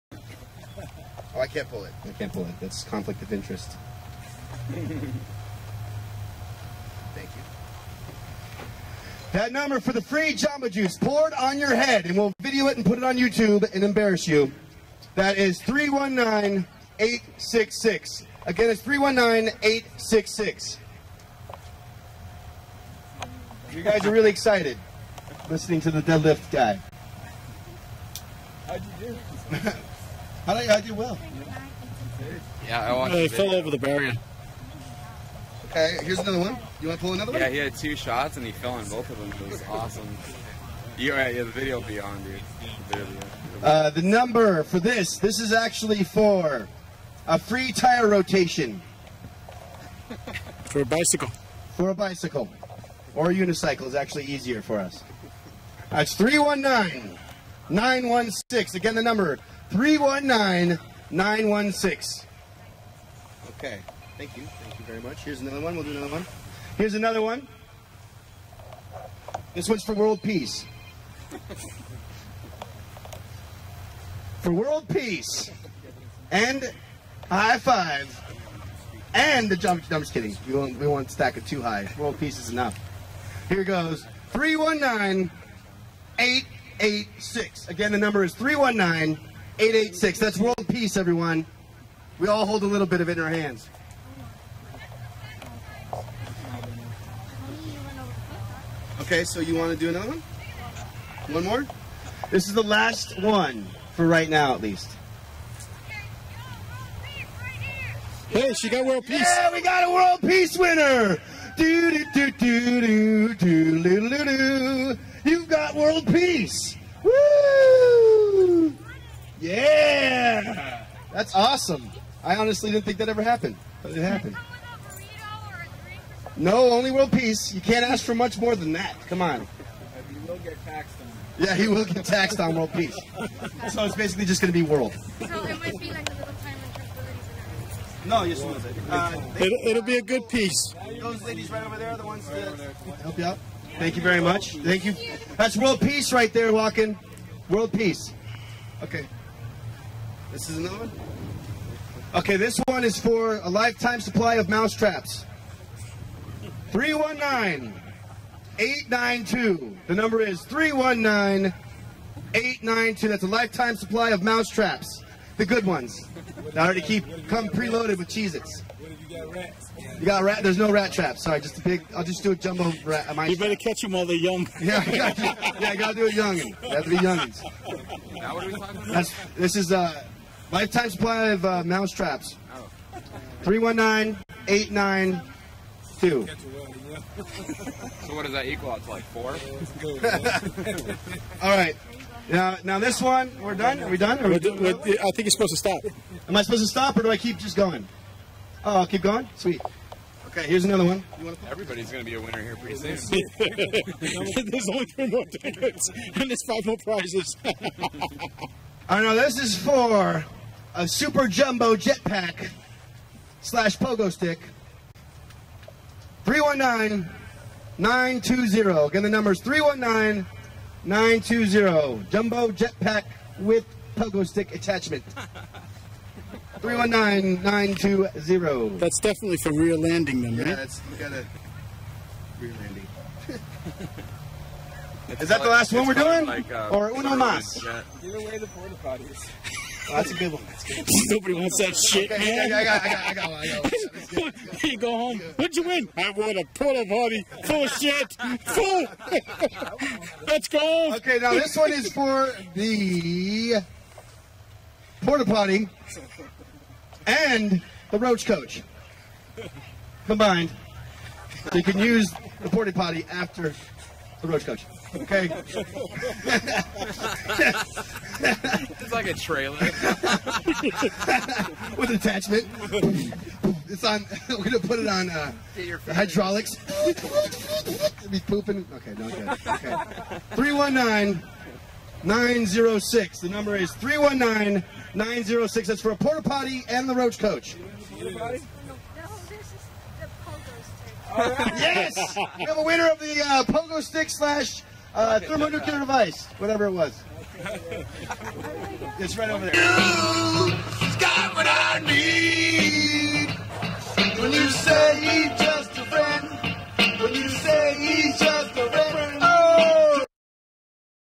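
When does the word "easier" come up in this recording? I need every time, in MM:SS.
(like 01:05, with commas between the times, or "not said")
00:54.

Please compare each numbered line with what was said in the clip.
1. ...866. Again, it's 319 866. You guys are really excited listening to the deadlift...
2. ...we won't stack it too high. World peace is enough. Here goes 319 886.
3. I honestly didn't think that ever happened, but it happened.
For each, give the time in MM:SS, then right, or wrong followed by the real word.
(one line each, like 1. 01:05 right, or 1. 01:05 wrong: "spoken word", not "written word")
1. 00:16 right
2. 01:20 right
3. 02:02 right.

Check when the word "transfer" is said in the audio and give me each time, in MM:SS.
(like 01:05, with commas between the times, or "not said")
not said.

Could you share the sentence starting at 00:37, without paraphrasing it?
Yeah, he had two shots and he fell in both of them.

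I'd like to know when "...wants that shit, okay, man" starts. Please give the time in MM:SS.
04:01.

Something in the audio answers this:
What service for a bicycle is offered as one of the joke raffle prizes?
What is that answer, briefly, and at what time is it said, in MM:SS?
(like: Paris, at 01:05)
Tire rotation, at 00:47.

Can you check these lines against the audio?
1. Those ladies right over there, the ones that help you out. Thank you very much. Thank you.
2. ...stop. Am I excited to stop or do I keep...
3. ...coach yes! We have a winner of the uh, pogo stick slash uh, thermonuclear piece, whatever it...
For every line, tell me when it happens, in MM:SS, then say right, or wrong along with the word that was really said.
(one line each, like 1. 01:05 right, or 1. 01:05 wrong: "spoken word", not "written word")
1. 02:21 right
2. 03:15 wrong: "supposed", not "excited"
3. 04:47 wrong: "device", not "piece".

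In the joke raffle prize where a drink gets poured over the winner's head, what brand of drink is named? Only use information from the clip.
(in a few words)
Jamba Juice.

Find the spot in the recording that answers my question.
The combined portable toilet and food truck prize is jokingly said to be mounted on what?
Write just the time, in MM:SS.
04:35.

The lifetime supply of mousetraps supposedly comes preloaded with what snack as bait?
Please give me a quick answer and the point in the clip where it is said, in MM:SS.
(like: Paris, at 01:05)
Cheez-Its, at 02:48.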